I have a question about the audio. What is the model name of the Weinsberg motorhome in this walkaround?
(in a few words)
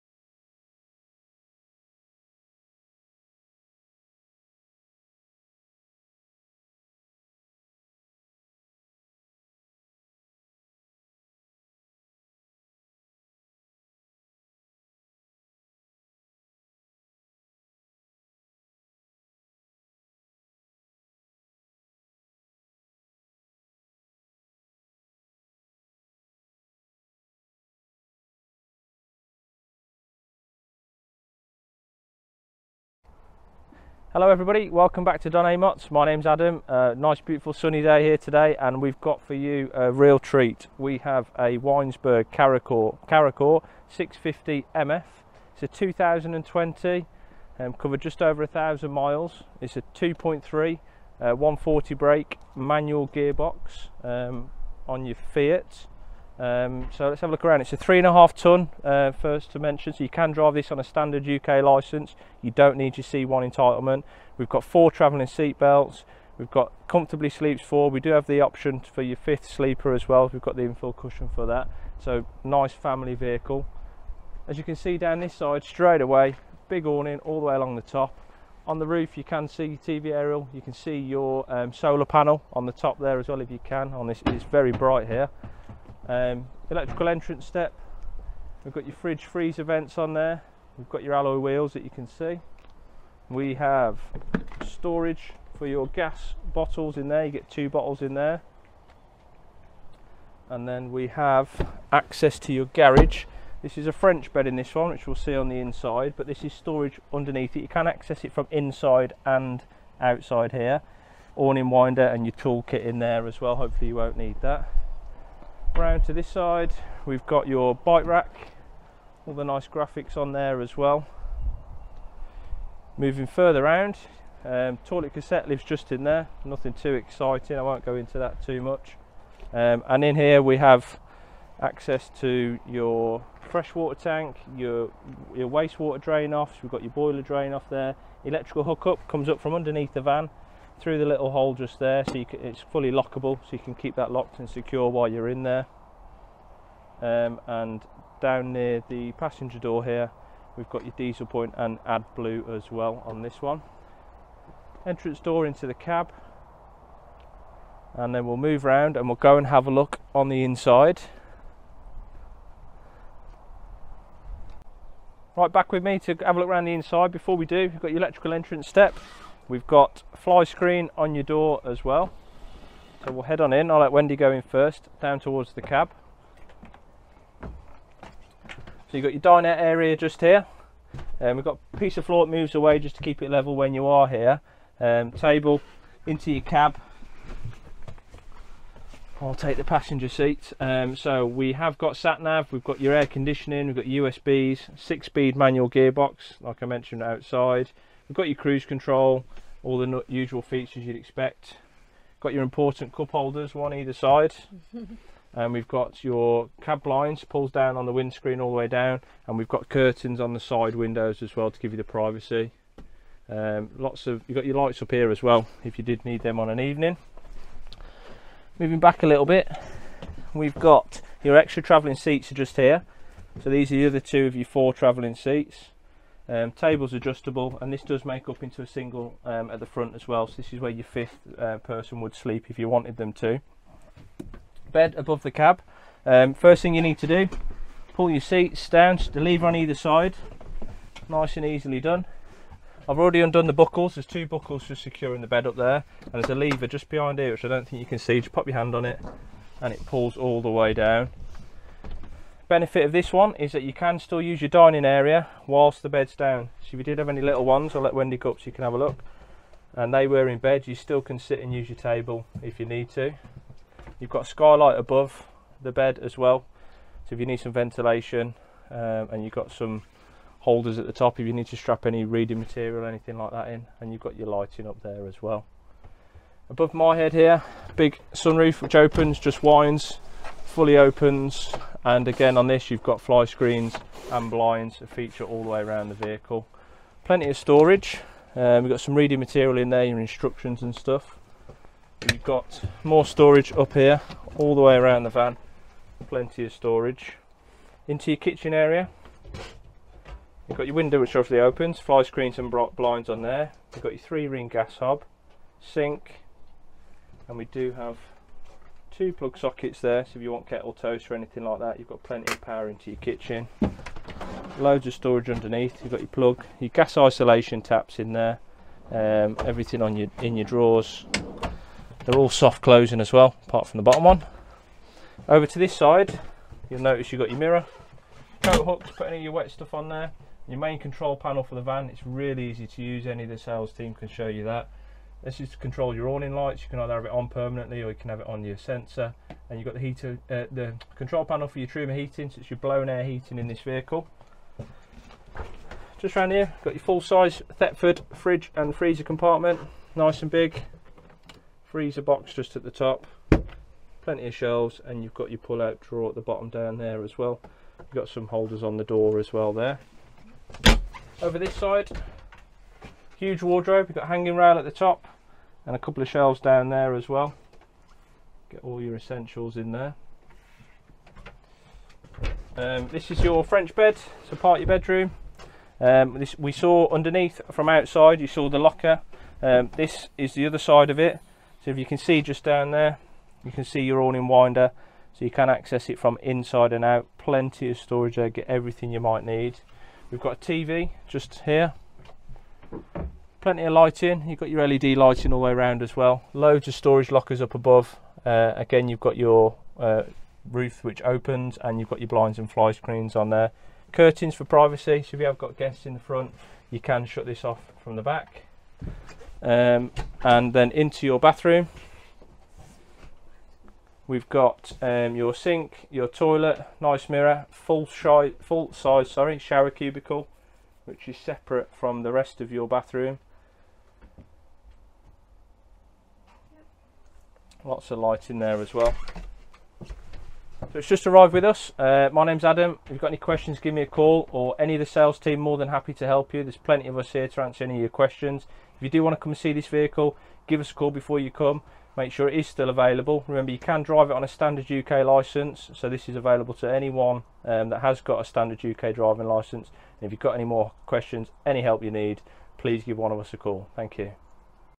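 CaraCore 650 MF.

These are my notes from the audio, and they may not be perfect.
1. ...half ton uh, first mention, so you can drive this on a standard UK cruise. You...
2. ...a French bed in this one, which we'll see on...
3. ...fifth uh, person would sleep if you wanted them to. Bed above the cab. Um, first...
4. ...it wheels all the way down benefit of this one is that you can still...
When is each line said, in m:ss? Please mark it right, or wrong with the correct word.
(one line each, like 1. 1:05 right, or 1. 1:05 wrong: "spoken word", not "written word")
1. 0:58 wrong: "license", not "cruise"
2. 1:43 right
3. 3:50 right
4. 4:09 wrong: "pulls", not "wheels".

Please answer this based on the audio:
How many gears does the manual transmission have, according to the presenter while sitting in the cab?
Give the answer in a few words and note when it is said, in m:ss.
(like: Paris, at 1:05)
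6, at 3:14.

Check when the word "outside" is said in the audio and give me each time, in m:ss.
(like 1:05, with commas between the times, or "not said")
1:50, 3:17, 6:17.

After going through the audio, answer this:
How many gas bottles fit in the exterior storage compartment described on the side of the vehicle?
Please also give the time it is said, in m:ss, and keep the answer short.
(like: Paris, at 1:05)
2, at 1:37.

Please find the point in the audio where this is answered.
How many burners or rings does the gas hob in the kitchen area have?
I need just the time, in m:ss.
5:03.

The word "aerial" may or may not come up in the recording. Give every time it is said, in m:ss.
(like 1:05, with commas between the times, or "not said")
1:20.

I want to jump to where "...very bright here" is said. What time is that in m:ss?
1:24.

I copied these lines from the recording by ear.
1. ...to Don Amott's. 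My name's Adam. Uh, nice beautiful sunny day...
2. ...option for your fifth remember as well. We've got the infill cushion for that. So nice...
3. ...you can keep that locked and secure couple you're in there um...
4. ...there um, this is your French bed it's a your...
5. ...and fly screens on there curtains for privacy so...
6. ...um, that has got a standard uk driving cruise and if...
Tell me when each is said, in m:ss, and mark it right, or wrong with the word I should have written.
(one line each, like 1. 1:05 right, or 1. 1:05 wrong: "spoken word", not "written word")
1. 0:35 right
2. 1:08 wrong: "sleeper", not "remember"
3. 2:23 wrong: "while", not "couple"
4. 6:09 right
5. 6:42 right
6. 7:27 wrong: "license", not "cruise".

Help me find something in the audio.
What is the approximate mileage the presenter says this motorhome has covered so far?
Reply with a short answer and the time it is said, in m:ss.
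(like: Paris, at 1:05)
Just over 1,000 miles, at 0:48.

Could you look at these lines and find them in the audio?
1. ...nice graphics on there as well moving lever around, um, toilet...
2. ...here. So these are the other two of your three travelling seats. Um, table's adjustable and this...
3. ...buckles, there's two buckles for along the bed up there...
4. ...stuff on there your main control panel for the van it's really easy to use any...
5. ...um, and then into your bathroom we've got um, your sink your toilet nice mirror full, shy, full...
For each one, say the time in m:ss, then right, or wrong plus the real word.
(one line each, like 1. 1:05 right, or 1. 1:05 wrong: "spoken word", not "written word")
1. 1:59 wrong: "further", not "lever"
2. 3:42 wrong: "four", not "three"
3. 4:03 wrong: "securing", not "along"
4. 5:29 right
5. 6:49 right.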